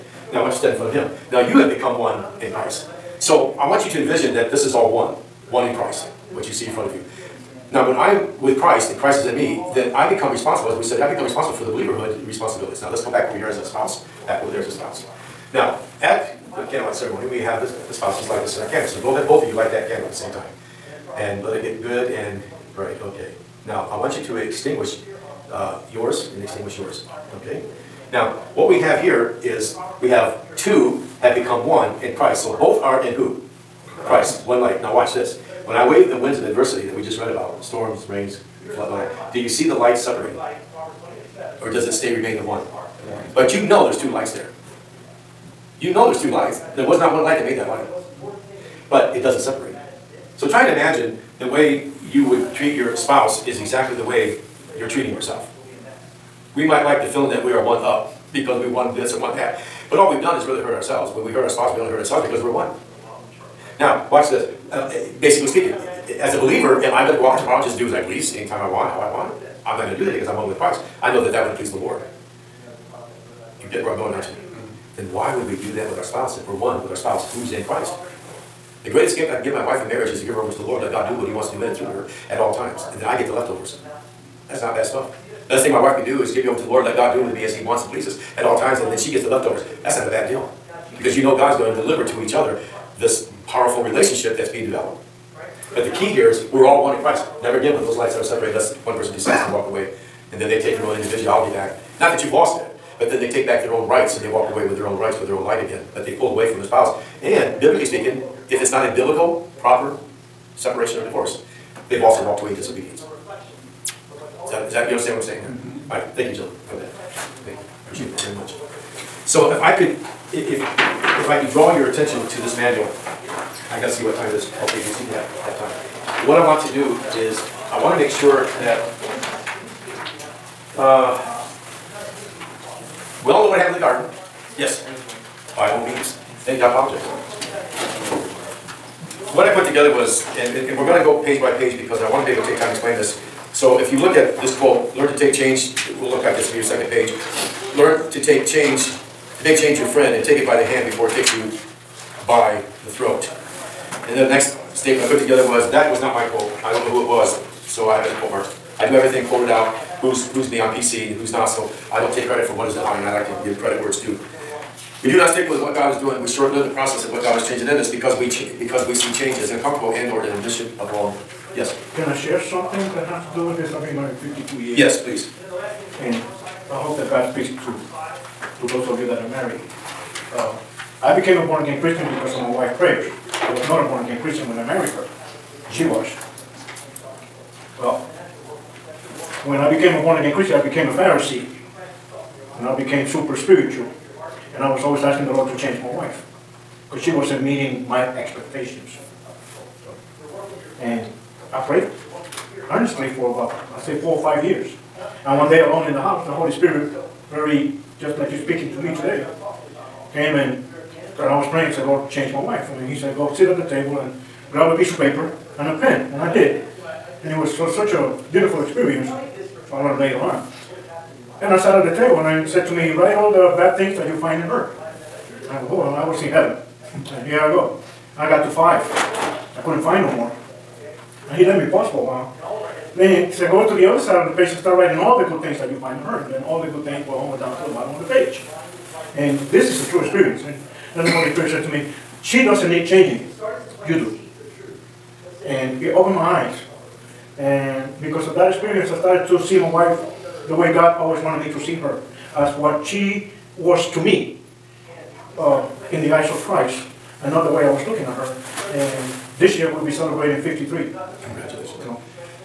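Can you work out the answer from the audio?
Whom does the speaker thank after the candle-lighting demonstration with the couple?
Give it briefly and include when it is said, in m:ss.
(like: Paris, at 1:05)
Jill, at 1:56.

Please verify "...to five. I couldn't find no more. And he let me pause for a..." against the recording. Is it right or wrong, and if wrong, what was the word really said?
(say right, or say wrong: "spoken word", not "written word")
right.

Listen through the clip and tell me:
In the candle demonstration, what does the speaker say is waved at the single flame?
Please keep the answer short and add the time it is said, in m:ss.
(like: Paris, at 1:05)
The winds of adversity, at 0:36.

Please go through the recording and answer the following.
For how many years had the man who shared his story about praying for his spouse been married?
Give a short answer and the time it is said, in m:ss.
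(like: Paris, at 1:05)
52, at 2:54.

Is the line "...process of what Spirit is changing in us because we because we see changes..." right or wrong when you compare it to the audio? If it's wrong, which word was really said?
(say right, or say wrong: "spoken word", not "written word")
wrong: "God", not "Spirit".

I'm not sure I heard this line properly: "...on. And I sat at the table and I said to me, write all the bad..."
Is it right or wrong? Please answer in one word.
right.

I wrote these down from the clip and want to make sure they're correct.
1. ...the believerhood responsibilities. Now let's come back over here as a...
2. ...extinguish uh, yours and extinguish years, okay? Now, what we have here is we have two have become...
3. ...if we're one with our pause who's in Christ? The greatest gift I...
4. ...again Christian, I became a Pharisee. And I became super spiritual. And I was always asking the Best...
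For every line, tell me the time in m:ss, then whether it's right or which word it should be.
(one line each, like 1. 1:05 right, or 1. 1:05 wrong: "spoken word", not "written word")
1. 0:11 right
2. 0:24 wrong: "yours", not "years"
3. 1:16 wrong: "spouse", not "pause"
4. 3:10 wrong: "Lord", not "Best".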